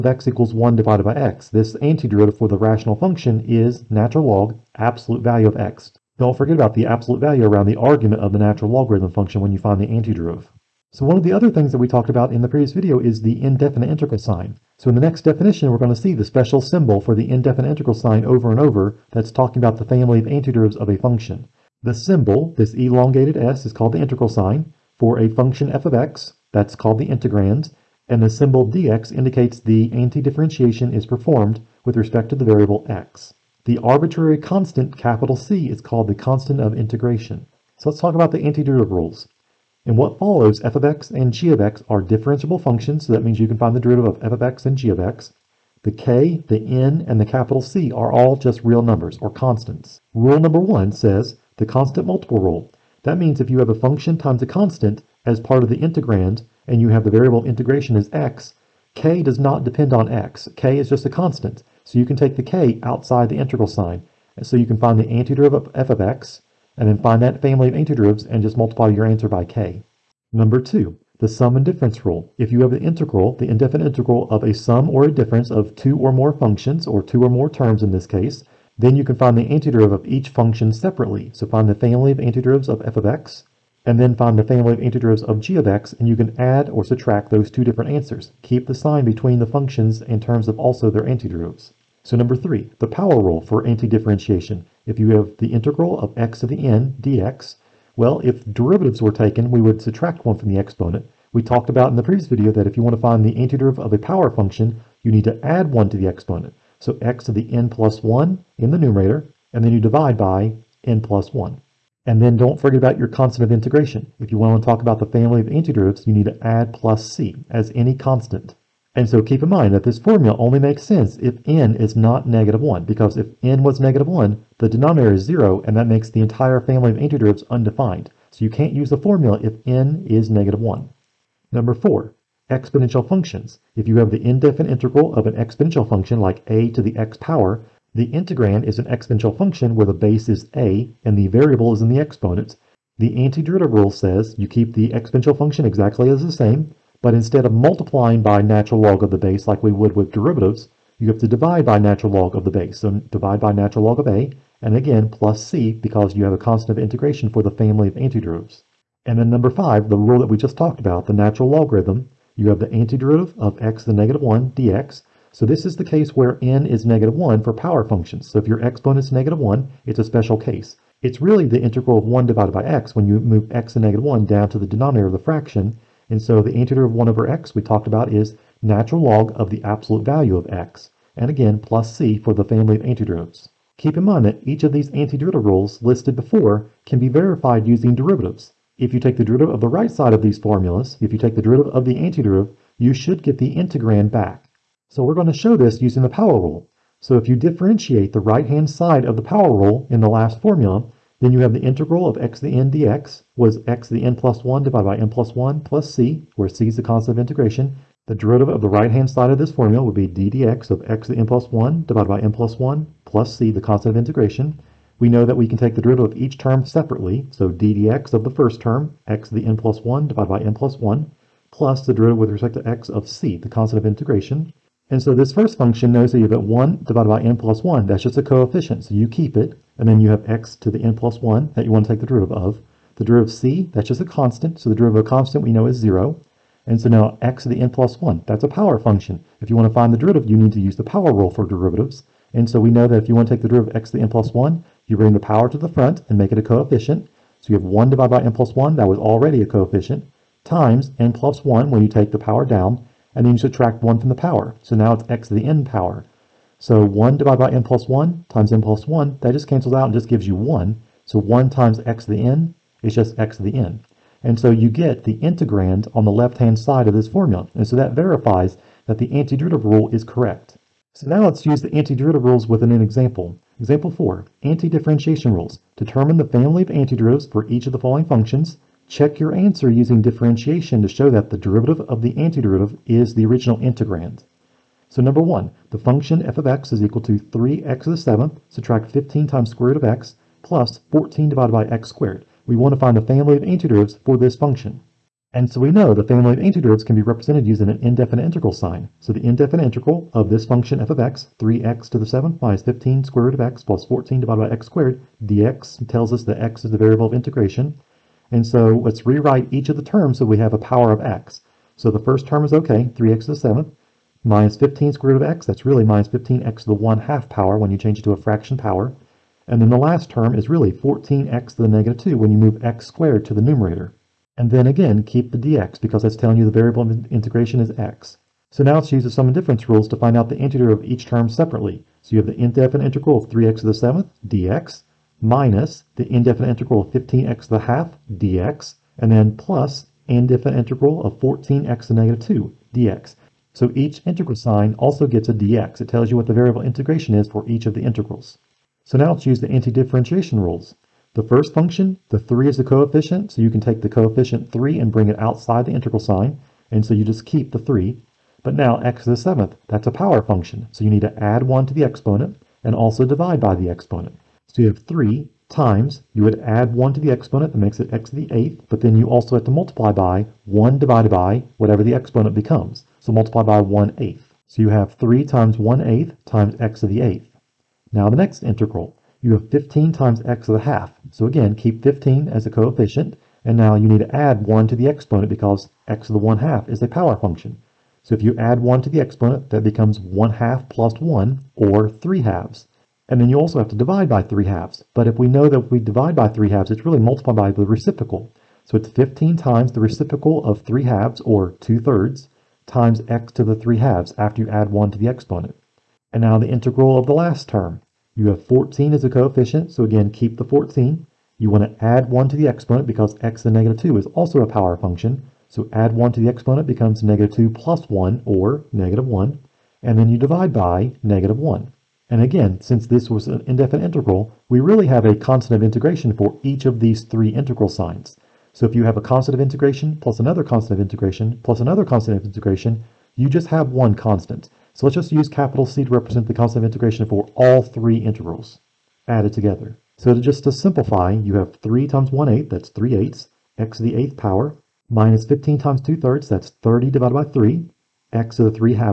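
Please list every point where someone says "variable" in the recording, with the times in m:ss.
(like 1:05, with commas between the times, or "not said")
0:32, 0:57, 2:21, 5:06, 5:26, 5:46.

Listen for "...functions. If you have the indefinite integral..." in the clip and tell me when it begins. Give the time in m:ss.
2:13.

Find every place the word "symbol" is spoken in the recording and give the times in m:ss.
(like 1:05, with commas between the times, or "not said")
0:16, 0:21, 0:28.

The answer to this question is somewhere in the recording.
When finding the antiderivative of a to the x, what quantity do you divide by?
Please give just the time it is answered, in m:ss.
2:33.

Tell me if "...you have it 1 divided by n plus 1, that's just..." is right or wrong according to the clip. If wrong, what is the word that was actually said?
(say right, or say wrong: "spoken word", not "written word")
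right.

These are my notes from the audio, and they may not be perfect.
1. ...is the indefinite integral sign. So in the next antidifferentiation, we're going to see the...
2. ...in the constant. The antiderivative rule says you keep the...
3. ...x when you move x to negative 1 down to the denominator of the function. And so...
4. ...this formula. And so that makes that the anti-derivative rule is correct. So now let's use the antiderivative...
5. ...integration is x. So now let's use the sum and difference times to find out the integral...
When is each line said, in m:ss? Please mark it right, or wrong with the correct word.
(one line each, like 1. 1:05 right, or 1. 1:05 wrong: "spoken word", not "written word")
1. 0:12 wrong: "definition", not "antidifferentiation"
2. 2:21 wrong: "exponent", not "constant"
3. 2:52 wrong: "fraction", not "function"
4. 4:26 wrong: "verifies", not "makes"
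5. 5:26 wrong: "rules", not "times".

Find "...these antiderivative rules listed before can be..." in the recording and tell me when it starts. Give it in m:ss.
3:04.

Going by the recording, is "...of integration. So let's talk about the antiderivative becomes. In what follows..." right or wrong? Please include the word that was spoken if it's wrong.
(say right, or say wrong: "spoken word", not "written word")
wrong: "rules", not "becomes".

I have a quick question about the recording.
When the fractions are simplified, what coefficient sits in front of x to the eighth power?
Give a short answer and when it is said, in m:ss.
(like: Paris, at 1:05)
3/8, at 7:22.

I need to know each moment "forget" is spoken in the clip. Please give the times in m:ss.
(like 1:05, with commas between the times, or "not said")
0:06, 1:52.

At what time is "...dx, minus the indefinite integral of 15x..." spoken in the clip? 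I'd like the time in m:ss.
5:34.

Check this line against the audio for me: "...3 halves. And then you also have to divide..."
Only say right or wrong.
right.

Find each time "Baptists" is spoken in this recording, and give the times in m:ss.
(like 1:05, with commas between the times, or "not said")
not said.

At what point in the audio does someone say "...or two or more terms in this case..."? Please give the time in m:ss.
1:16.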